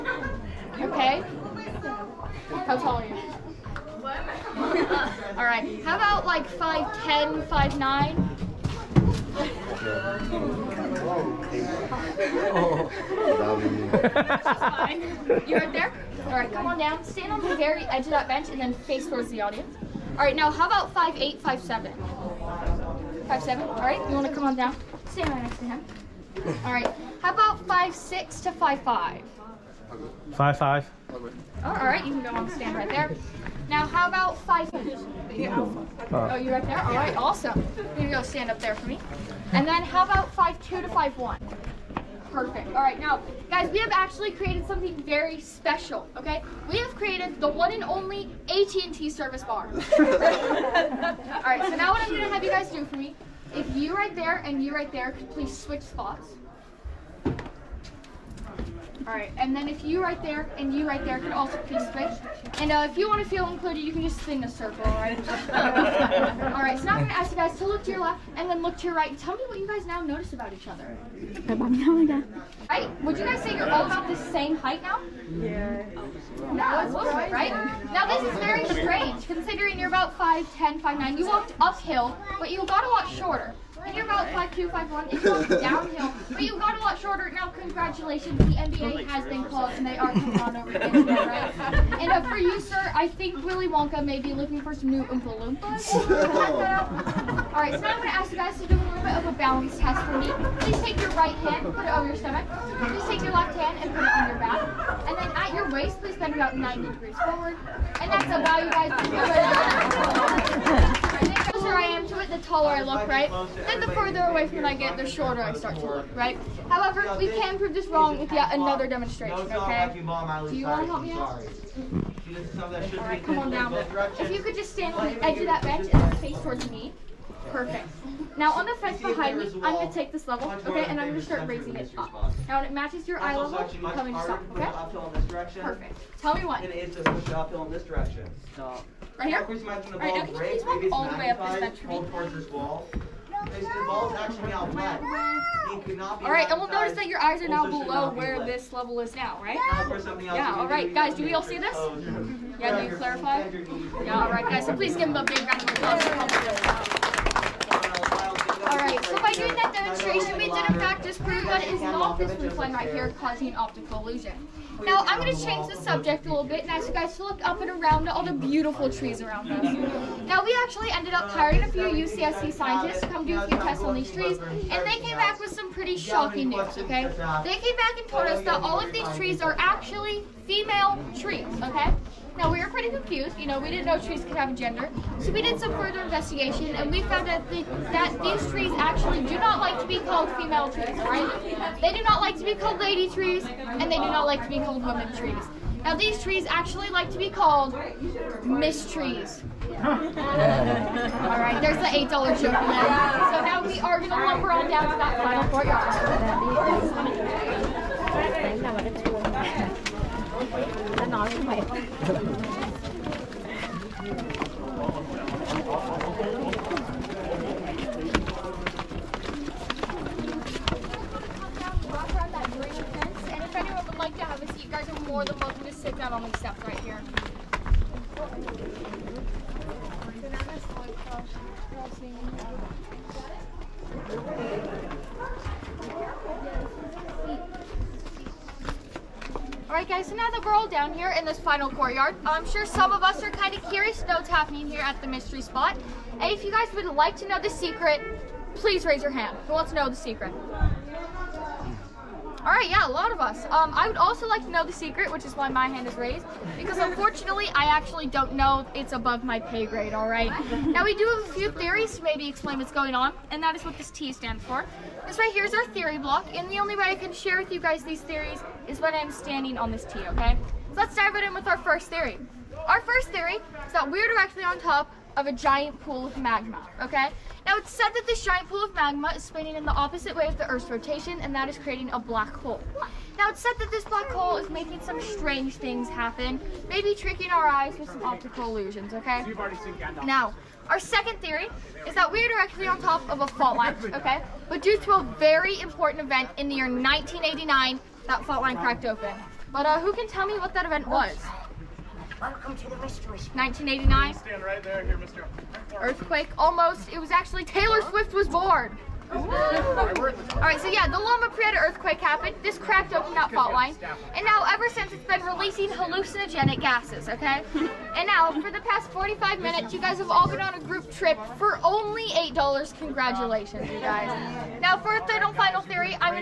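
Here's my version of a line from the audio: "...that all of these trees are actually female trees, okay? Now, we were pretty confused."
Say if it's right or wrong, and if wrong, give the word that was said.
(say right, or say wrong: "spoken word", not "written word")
right.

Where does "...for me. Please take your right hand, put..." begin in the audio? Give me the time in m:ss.
1:40.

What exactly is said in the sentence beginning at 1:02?
And uh, if you want to feel included, you can just spin a circle, all right?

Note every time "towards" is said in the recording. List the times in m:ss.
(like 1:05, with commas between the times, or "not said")
0:19, 2:06.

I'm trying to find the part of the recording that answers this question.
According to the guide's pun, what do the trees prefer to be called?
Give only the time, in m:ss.
3:18.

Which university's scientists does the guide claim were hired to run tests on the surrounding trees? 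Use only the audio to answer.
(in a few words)
UCSC.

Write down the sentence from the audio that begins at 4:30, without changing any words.
So let's dive right in with our first theory.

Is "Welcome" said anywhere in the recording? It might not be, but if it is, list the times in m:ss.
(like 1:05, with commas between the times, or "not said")
5:02.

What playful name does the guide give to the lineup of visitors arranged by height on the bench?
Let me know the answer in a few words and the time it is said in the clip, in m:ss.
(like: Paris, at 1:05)
AT&T service bar, at 0:48.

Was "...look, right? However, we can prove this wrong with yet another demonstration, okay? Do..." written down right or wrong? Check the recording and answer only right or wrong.
right.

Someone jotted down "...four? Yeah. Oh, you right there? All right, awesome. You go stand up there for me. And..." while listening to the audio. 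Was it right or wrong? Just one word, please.
wrong.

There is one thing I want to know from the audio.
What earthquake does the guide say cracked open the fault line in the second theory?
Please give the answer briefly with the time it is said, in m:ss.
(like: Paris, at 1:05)
Loma Prieta earthquake, at 5:10.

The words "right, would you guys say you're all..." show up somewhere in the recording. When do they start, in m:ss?
1:12.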